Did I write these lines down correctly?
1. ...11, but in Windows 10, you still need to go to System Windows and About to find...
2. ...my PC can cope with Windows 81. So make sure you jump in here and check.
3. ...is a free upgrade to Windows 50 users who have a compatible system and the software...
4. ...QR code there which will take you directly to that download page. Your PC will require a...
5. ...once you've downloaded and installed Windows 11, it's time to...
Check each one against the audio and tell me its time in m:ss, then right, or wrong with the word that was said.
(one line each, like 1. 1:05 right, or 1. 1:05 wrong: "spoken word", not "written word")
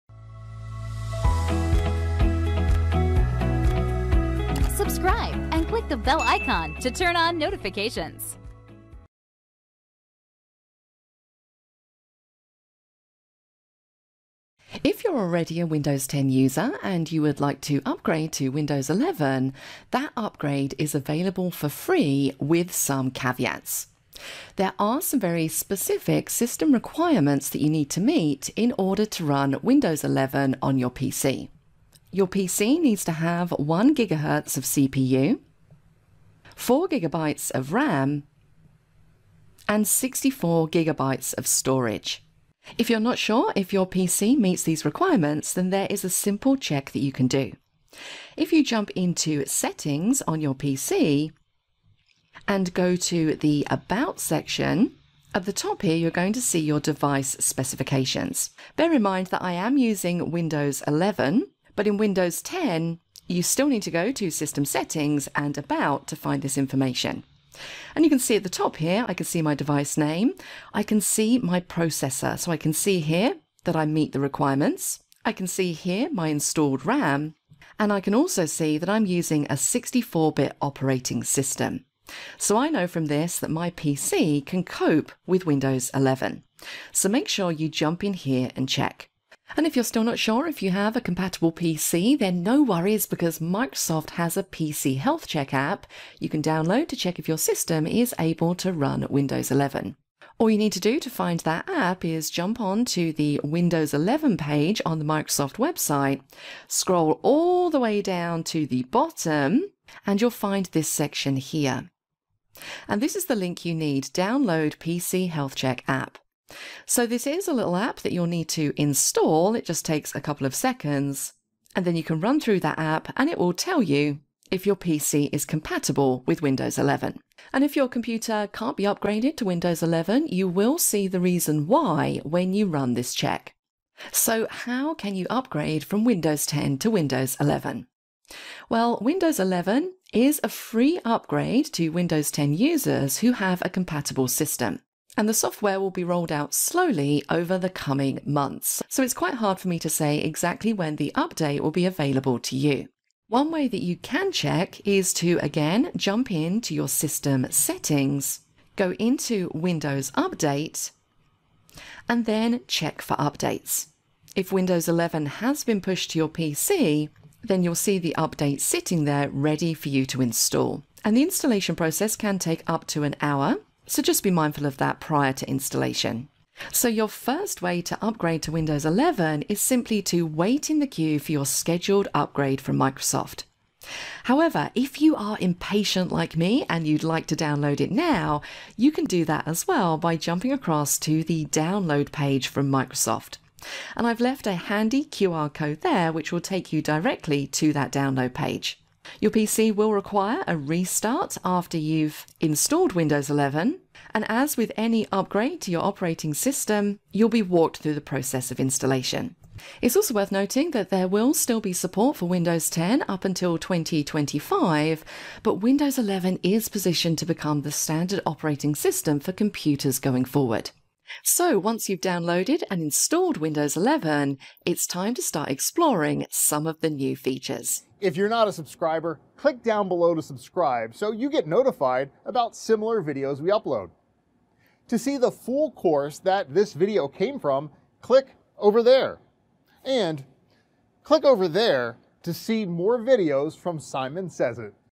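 1. 1:00 wrong: "Settings", not "Windows"
2. 1:23 wrong: "11", not "81"
3. 2:20 wrong: "10", not "50"
4. 3:15 right
5. 3:41 right.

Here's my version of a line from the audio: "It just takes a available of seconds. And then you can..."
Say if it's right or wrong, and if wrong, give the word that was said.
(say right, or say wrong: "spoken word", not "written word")
wrong: "couple", not "available".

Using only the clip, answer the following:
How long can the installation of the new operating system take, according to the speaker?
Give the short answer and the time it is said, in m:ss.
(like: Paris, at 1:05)
Up to an hour, at 2:52.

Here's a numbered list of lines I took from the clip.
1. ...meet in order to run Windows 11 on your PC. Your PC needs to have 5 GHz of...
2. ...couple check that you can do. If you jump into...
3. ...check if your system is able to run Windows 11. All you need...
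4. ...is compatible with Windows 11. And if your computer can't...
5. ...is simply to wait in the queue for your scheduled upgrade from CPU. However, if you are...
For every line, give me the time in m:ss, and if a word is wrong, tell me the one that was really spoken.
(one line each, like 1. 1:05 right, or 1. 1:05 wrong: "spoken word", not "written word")
1. 0:27 wrong: "1", not "5"
2. 0:46 wrong: "simple", not "couple"
3. 1:36 right
4. 2:05 right
5. 2:59 wrong: "Microsoft", not "CPU".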